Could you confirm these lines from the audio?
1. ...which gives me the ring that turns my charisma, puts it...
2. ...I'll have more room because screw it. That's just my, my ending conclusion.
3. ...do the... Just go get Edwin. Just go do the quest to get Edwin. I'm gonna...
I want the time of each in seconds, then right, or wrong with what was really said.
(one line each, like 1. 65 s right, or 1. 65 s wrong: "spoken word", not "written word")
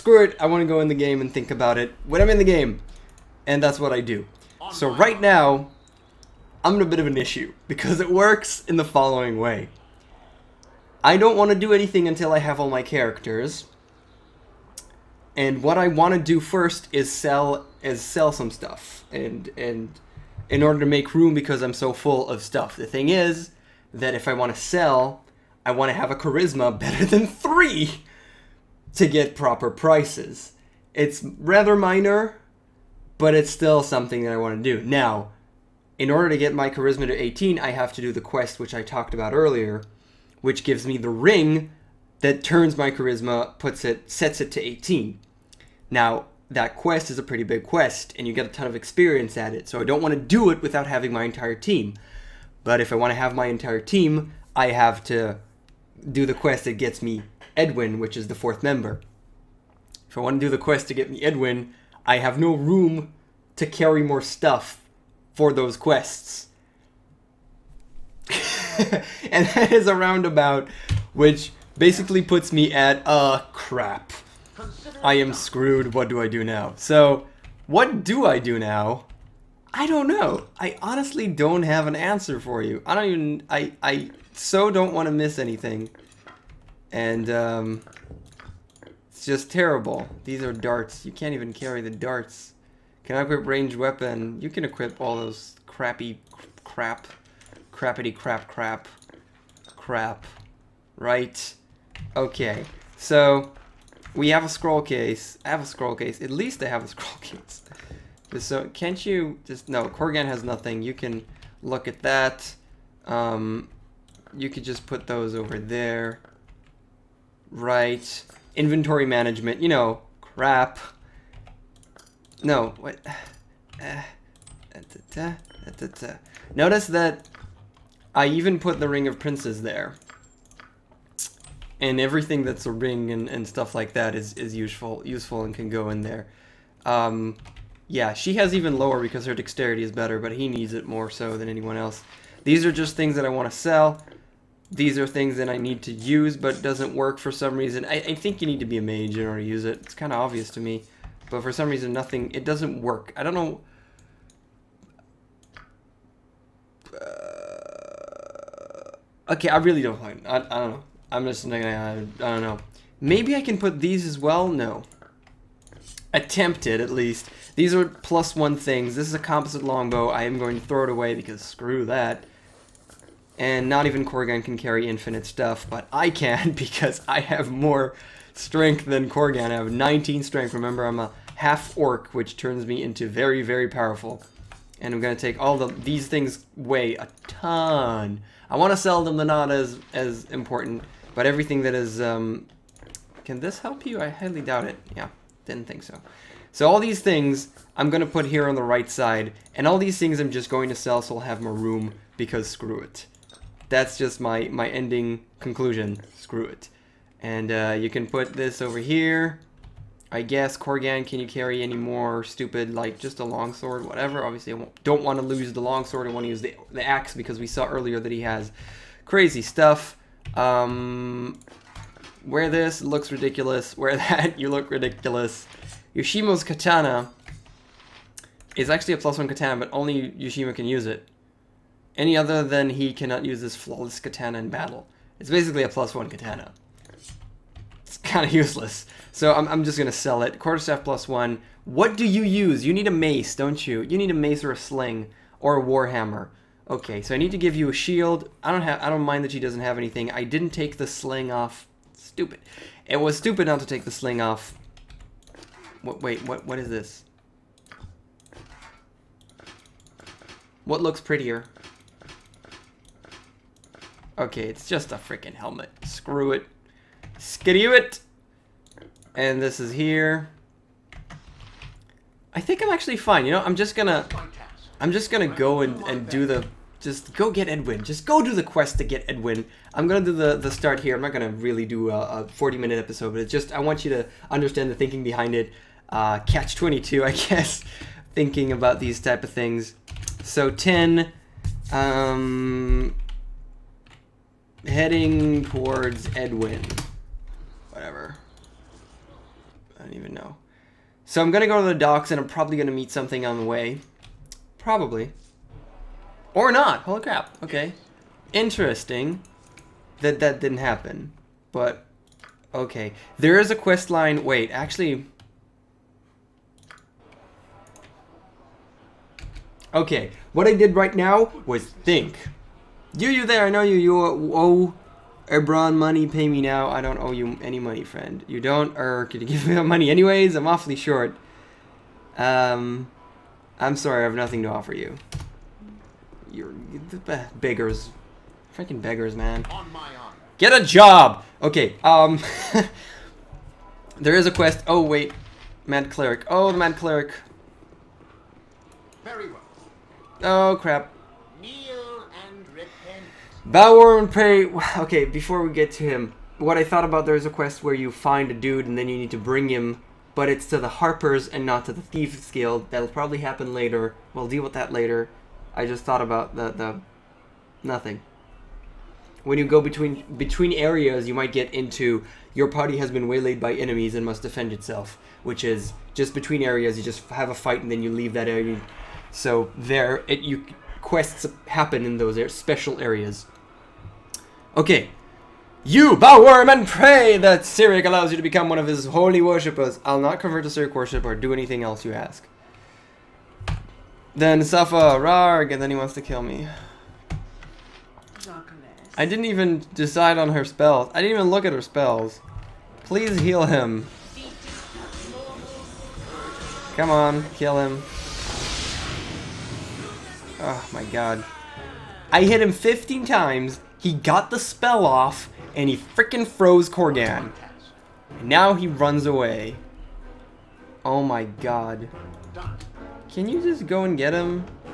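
1. 40 s right
2. 201 s right
3. 276 s right.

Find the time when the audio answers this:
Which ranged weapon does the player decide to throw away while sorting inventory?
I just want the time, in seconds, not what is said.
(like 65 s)
169 s.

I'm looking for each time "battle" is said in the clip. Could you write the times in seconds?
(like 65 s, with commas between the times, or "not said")
234 s.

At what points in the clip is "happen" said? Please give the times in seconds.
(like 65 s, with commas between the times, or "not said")
310 s, 363 s, 381 s.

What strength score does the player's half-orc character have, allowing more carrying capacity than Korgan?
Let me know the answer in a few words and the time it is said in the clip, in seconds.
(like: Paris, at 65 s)
19, at 179 s.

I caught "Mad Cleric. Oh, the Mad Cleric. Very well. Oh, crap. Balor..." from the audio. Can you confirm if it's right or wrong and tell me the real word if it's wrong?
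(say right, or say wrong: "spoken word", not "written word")
right.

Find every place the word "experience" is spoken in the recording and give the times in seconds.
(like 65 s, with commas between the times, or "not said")
48 s.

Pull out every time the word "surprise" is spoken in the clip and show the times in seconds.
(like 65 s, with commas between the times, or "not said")
not said.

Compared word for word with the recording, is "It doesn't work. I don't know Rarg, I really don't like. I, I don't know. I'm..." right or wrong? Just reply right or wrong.
wrong.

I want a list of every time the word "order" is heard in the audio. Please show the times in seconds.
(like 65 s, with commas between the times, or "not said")
20 s, 36 s, 149 s.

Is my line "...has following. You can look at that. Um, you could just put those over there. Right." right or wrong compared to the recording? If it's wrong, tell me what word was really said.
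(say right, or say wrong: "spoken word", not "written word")
wrong: "nothing", not "following".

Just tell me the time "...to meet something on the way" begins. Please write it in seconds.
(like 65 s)
302 s.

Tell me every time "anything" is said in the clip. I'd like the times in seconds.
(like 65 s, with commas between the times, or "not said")
11 s, 85 s, 249 s, 391 s.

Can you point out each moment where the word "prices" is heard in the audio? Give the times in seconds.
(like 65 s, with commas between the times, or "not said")
29 s.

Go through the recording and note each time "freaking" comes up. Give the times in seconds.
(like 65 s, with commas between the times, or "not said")
264 s, 338 s, 415 s.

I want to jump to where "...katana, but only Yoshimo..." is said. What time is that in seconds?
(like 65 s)
229 s.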